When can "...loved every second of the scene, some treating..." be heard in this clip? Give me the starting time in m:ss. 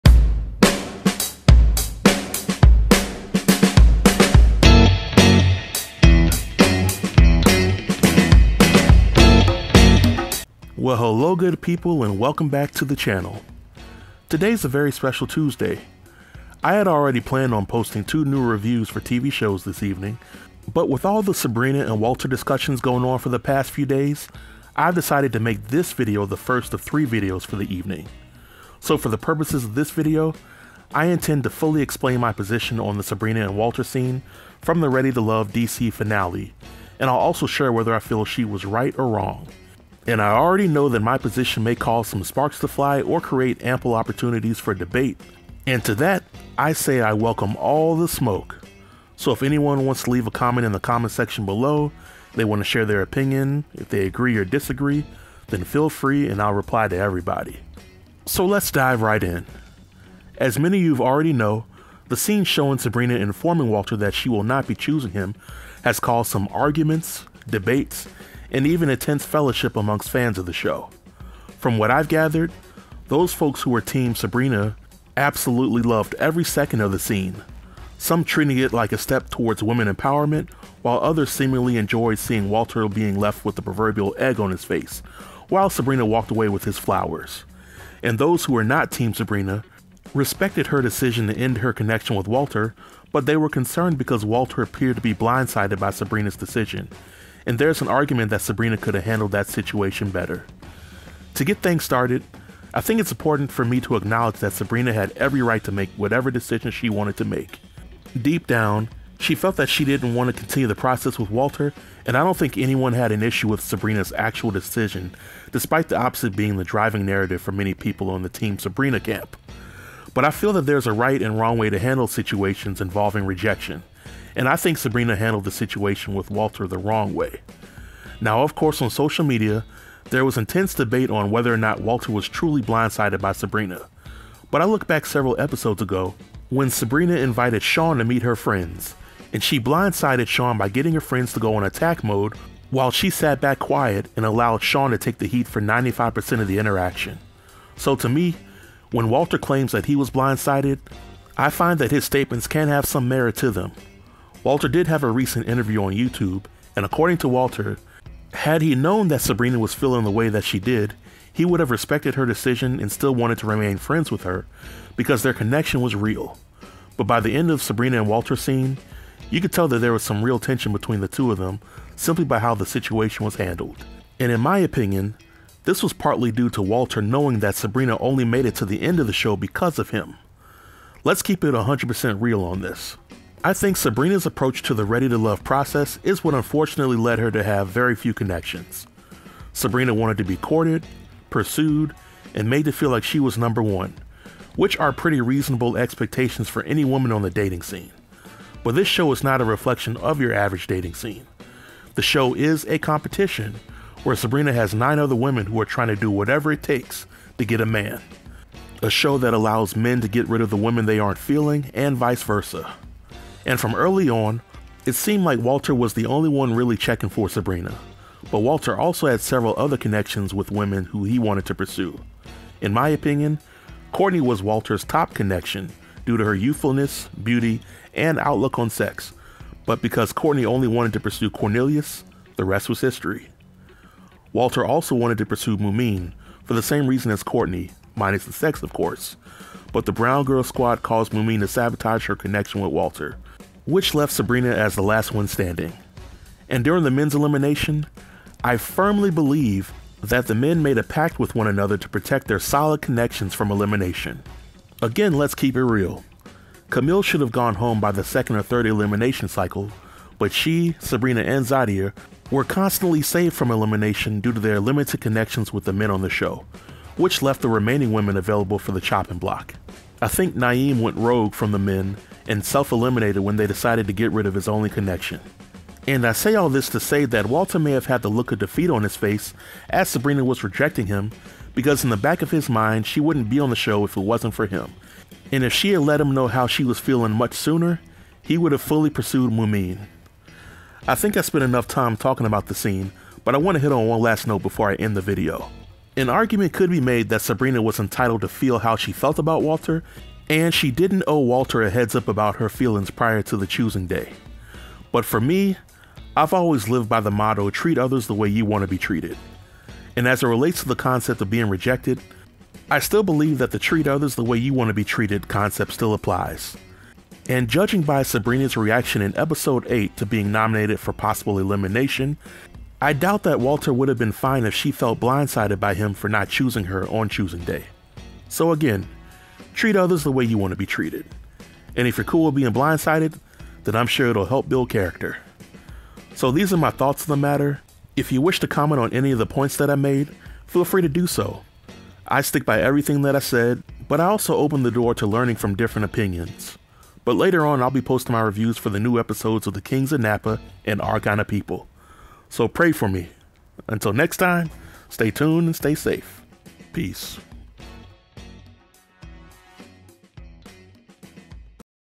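1:15.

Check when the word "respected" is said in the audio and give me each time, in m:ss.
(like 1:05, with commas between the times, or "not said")
1:30, 2:41.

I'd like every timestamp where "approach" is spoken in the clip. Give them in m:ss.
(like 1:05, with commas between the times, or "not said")
3:04.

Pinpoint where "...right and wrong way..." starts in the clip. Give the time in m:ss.
2:00.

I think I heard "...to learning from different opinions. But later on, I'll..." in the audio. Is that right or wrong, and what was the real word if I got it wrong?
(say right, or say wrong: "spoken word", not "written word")
right.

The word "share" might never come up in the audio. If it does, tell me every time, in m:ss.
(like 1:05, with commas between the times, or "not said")
0:37, 0:52.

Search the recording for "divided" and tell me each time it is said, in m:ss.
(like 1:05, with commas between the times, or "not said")
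not said.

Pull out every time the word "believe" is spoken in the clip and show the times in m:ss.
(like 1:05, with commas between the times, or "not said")
4:09, 5:13.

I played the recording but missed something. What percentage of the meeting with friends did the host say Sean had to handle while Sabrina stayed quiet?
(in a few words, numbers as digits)
95%.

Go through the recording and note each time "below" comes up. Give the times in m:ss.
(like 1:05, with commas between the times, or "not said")
0:51.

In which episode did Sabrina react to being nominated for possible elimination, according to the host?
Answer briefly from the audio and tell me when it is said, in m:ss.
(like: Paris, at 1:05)
8, at 5:19.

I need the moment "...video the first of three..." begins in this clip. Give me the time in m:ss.
0:25.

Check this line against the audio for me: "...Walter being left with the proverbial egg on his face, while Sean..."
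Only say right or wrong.
wrong.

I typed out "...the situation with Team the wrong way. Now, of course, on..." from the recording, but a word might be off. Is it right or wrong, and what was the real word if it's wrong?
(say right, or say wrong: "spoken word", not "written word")
wrong: "Walter", not "Team".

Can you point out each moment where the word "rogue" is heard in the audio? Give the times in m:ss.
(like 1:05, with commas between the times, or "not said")
4:30.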